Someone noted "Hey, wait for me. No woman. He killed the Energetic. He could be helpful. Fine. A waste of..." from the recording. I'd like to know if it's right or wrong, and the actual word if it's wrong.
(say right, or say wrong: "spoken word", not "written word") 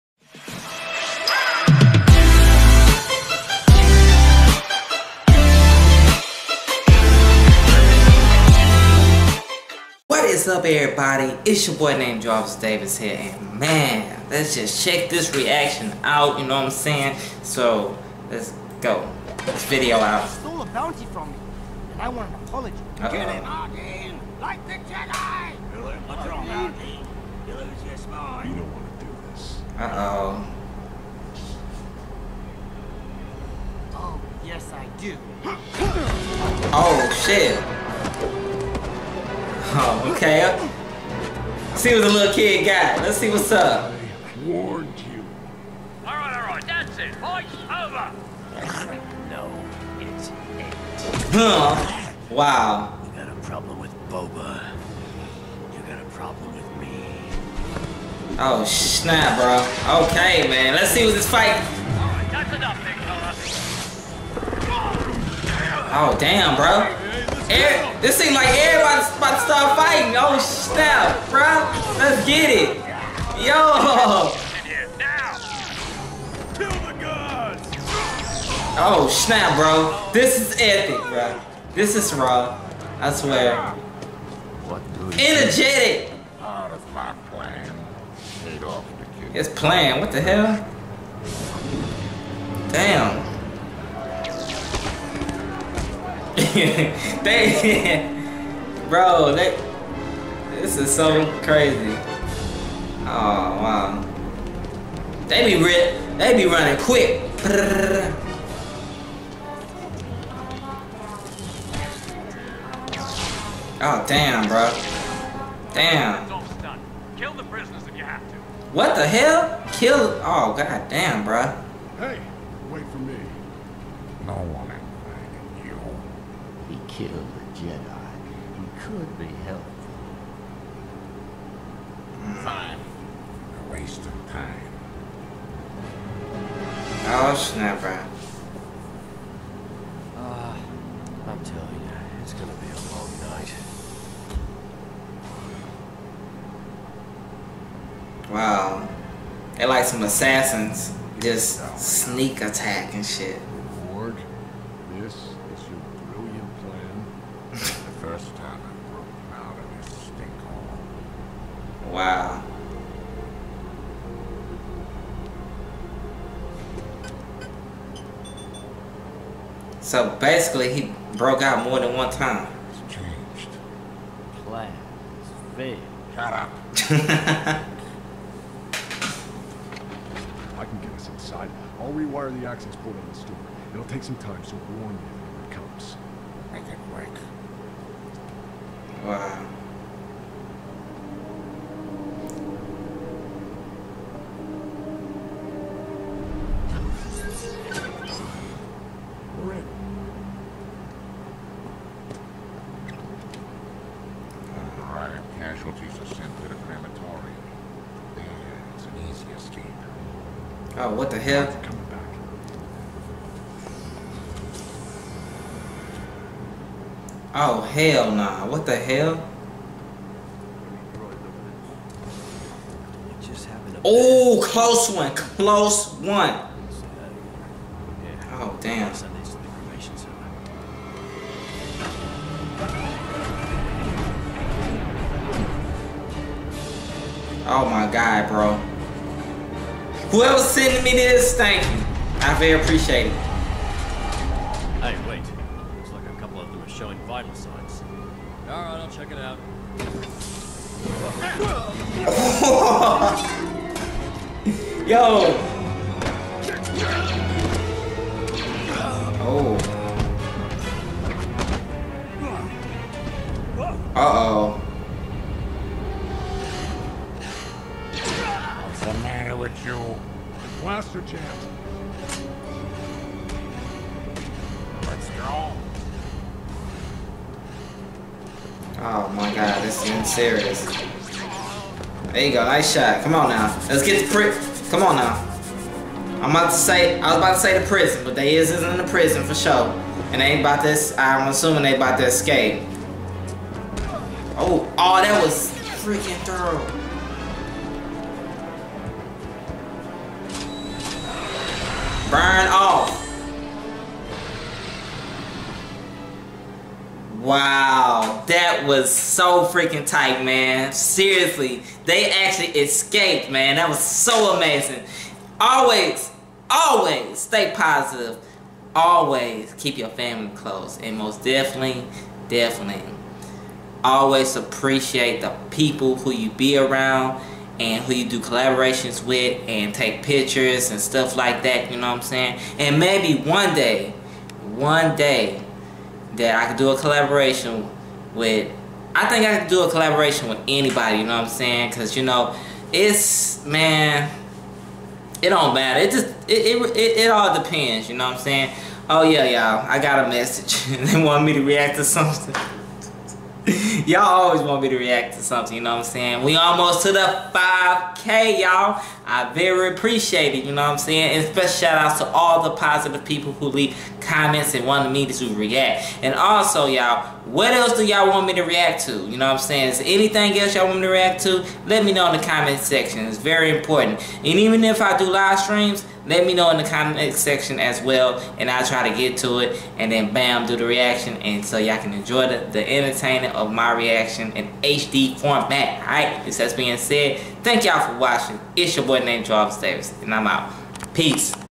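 wrong: "Jedi", not "Energetic".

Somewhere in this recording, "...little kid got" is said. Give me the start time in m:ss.
0:42.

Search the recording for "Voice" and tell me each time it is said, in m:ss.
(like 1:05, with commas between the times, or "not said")
0:47.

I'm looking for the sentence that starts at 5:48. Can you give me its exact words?
Oh, yeah, y'all, I got a message.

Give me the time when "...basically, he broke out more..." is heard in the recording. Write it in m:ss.
2:50.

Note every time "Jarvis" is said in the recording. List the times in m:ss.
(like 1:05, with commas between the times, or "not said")
0:12, 6:29.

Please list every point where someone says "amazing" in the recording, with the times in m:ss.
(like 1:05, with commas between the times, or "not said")
5:14.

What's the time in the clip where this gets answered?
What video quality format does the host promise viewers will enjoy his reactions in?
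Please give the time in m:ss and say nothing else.
6:24.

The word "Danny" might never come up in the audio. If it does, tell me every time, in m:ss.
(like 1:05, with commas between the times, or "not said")
not said.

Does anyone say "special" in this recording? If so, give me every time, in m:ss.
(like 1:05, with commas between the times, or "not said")
6:01.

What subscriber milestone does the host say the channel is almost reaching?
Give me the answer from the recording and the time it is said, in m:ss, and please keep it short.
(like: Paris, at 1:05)
5K, at 5:57.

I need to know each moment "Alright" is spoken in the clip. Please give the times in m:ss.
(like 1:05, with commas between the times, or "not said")
4:08, 6:25.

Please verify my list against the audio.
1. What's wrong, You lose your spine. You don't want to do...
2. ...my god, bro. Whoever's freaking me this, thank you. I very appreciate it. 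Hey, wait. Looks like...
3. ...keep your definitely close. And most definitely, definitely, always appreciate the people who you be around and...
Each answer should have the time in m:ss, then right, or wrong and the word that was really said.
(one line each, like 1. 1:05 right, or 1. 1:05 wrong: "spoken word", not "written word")
1. 0:26 right
2. 3:57 wrong: "sending", not "freaking"
3. 5:19 wrong: "family", not "definitely".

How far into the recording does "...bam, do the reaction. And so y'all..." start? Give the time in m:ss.
6:20.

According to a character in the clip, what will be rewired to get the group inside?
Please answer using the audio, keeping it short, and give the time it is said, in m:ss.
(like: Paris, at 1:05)
the access port, at 3:02.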